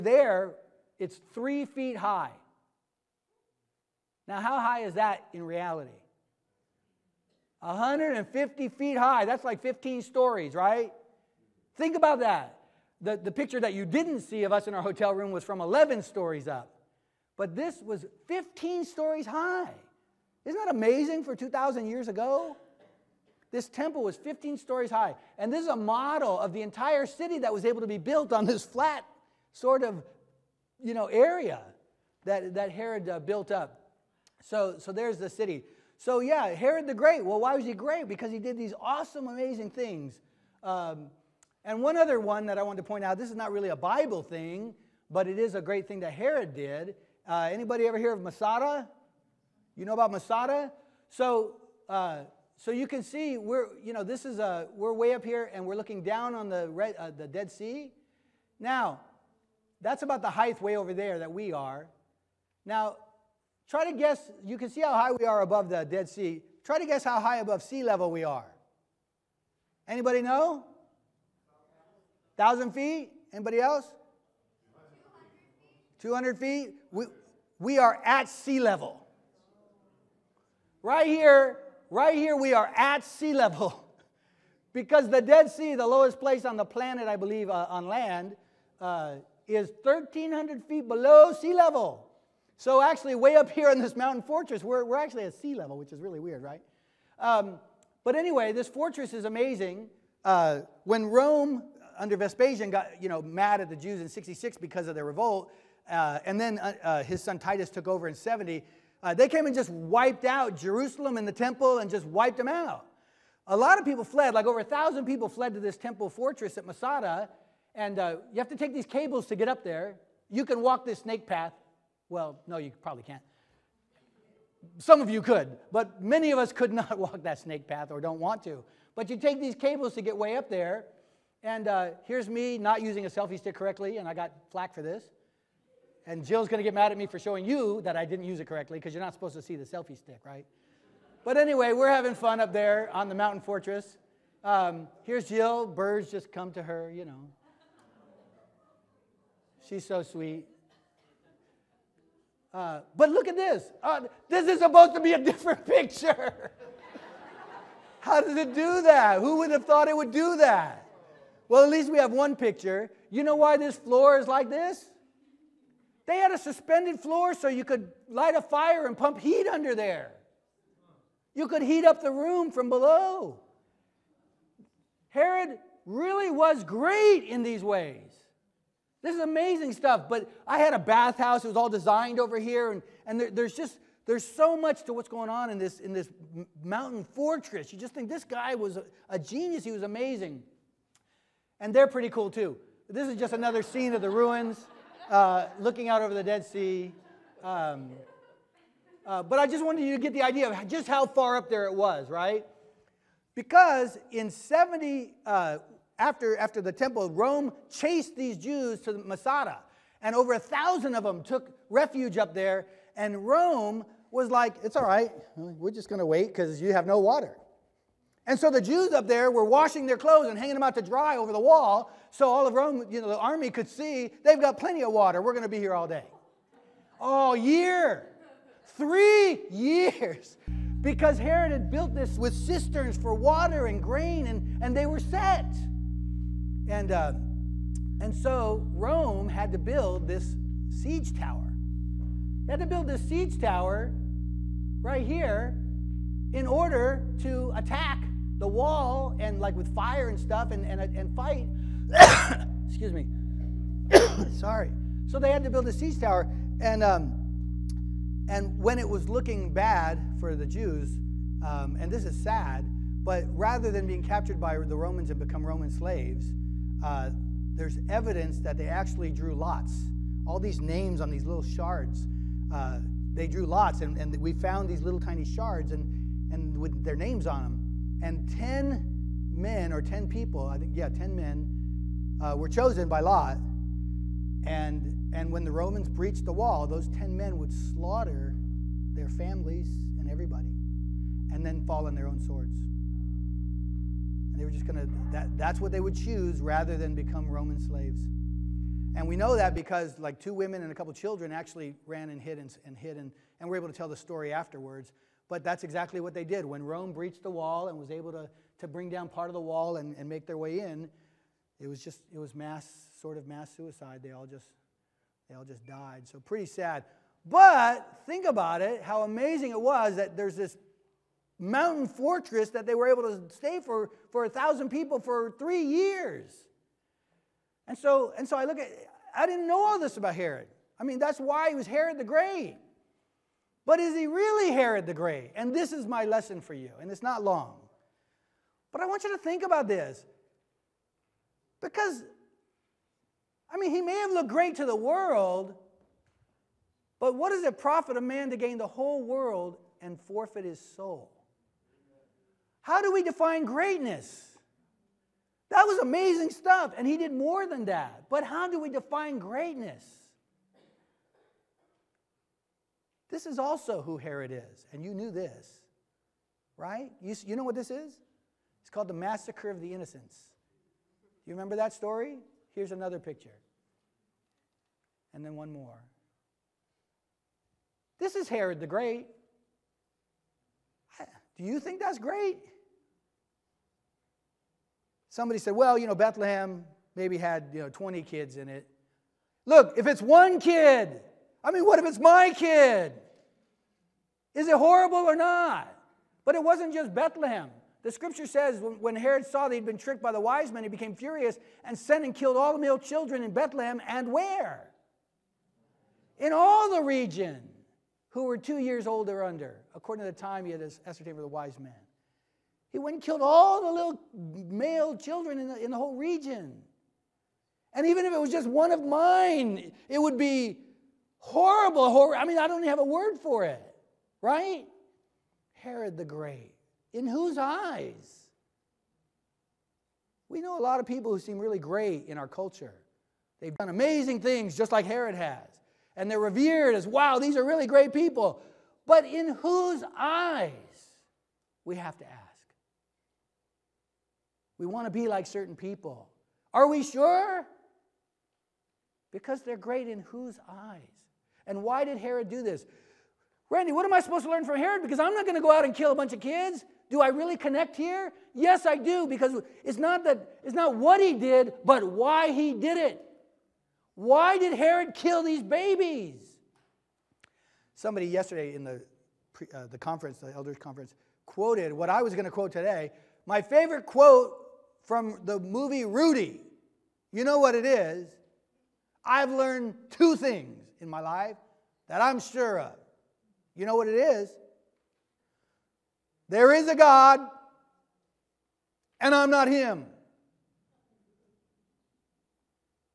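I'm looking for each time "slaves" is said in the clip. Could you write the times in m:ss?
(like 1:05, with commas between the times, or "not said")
4:25, 4:57.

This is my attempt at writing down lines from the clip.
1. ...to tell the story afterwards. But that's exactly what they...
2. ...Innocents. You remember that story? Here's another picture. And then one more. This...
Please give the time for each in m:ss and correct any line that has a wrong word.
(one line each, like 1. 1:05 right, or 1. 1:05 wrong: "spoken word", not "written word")
1. 5:03 right
2. 6:09 right.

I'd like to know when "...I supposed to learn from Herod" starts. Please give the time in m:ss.
7:33.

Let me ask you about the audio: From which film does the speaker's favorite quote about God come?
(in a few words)
Rudy.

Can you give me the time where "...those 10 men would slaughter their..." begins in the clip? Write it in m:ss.
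4:46.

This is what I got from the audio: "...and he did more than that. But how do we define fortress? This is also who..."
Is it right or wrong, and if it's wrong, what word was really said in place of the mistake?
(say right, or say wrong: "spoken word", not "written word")
wrong: "greatness", not "fortress".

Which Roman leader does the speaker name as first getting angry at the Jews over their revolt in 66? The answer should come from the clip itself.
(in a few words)
Vespasian.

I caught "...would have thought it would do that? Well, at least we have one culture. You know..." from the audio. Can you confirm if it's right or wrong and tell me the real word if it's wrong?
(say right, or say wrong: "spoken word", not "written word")
wrong: "picture", not "culture".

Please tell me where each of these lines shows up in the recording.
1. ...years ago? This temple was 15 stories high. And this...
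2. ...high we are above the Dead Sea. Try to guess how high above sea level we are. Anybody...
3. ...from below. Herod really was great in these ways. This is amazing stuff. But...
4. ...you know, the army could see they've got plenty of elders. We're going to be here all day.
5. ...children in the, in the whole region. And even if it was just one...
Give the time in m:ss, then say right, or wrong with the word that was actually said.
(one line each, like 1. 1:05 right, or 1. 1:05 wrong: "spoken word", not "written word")
1. 0:21 right
2. 1:04 right
3. 2:52 right
4. 3:42 wrong: "water", not "elders"
5. 6:54 right.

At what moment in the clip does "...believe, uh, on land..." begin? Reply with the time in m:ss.
1:27.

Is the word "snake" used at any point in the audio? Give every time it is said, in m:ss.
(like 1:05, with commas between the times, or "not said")
2:01, 2:07.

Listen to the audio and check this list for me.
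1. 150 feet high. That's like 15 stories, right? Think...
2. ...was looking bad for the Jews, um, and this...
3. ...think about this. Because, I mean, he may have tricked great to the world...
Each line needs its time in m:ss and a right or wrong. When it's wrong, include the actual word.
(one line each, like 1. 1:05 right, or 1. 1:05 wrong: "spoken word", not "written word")
1. 0:07 right
2. 4:18 right
3. 5:39 wrong: "looked", not "tricked".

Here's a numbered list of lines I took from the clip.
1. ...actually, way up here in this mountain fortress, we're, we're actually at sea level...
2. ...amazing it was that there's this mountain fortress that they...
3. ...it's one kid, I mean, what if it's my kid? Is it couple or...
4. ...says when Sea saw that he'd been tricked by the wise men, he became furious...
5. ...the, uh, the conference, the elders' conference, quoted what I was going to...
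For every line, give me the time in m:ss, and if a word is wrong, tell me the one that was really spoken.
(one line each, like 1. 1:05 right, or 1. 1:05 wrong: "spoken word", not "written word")
1. 1:32 right
2. 5:19 right
3. 6:29 wrong: "horrible", not "couple"
4. 6:38 wrong: "Herod", not "Sea"
5. 7:48 right.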